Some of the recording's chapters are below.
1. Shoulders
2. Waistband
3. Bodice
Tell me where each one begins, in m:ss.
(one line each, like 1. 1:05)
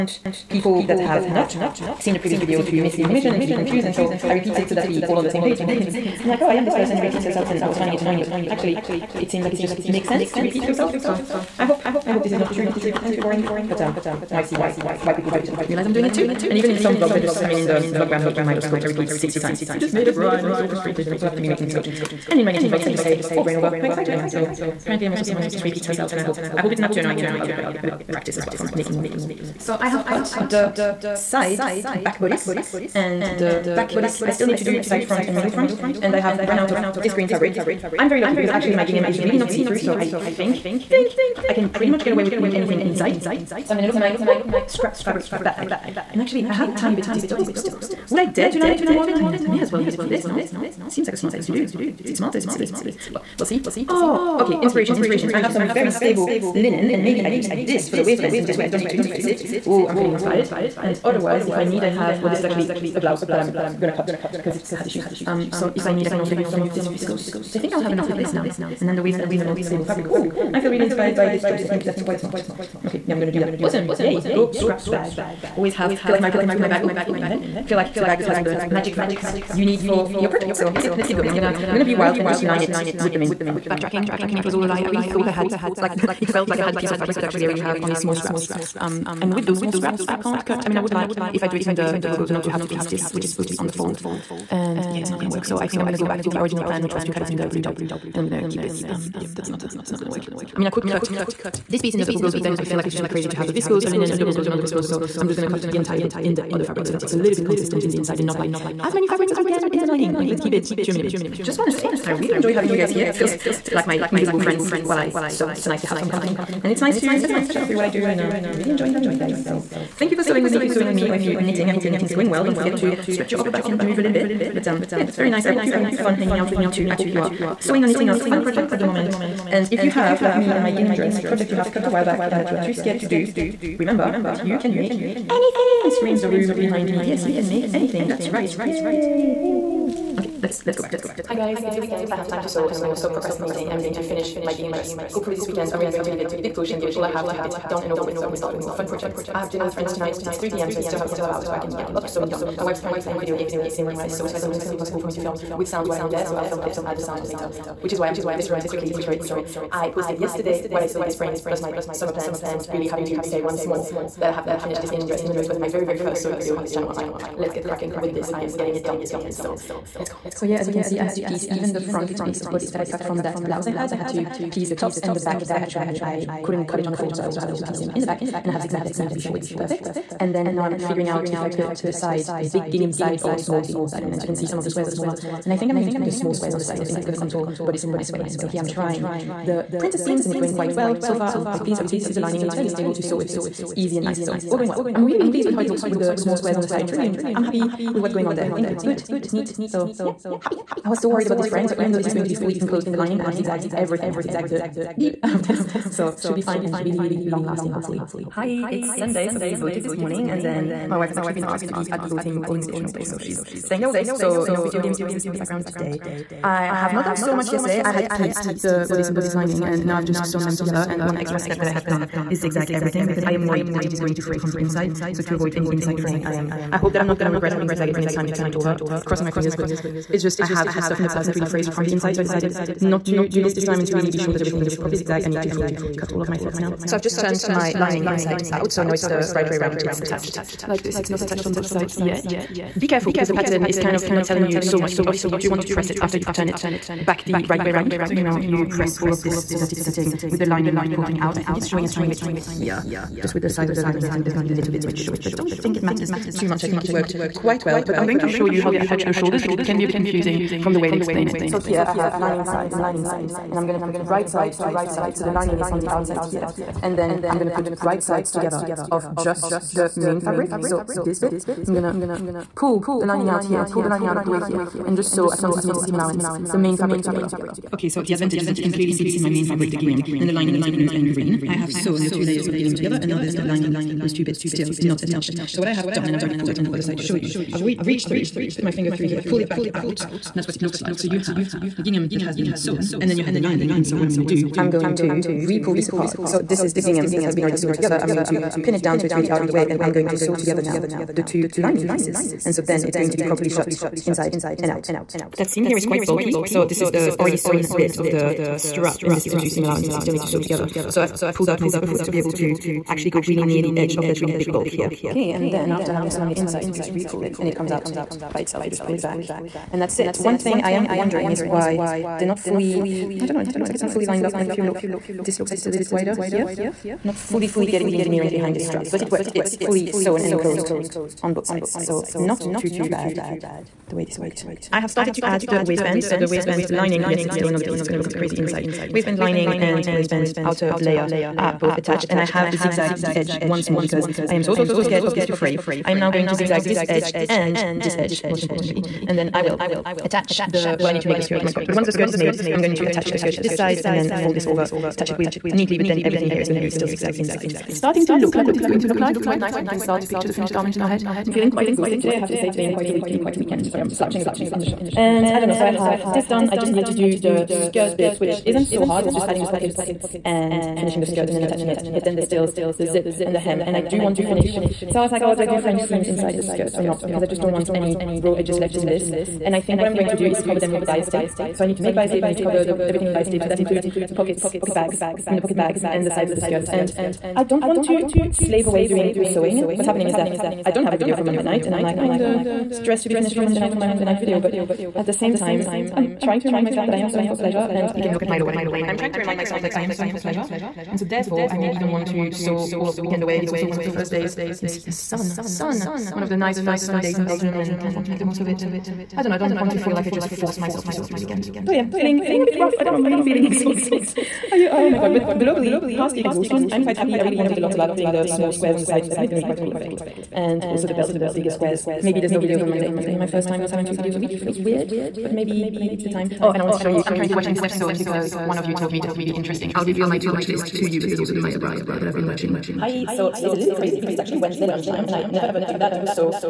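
1. 4:15
2. 5:36
3. 2:22.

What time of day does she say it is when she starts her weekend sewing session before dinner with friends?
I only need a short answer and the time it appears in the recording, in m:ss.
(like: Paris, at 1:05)
3 p.m., at 2:30.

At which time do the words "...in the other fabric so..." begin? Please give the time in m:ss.
1:46.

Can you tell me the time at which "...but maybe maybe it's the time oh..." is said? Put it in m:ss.
7:05.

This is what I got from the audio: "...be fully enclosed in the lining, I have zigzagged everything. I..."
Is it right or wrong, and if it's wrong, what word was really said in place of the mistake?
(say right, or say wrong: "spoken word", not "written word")
right.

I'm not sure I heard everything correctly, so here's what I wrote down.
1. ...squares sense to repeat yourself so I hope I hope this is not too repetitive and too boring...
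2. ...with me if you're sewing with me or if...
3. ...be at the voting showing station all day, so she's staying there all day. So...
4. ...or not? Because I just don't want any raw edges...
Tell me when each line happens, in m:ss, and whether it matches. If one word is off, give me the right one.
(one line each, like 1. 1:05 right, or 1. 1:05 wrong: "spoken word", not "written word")
1. 0:09 wrong: "makes", not "squares"
2. 2:00 right
3. 3:31 wrong: "polling", not "showing"
4. 6:16 right.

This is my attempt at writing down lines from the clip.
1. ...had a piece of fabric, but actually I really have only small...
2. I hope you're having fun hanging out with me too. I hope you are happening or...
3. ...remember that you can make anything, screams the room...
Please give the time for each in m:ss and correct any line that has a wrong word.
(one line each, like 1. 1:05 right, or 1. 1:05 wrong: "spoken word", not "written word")
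1. 1:26 right
2. 2:05 wrong: "sewing", not "happening"
3. 2:13 right.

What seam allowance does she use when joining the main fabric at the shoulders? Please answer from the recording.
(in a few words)
1 centimeter.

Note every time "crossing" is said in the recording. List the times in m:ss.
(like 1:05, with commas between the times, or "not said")
3:49.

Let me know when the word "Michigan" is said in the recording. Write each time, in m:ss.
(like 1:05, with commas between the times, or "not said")
not said.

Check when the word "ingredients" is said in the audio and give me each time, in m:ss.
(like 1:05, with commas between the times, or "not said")
not said.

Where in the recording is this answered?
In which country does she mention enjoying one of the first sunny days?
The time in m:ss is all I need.
6:47.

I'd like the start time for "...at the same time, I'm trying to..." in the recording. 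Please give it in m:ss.
6:34.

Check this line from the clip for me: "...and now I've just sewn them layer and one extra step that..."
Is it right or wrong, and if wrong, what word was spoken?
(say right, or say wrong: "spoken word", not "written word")
wrong: "together", not "layer".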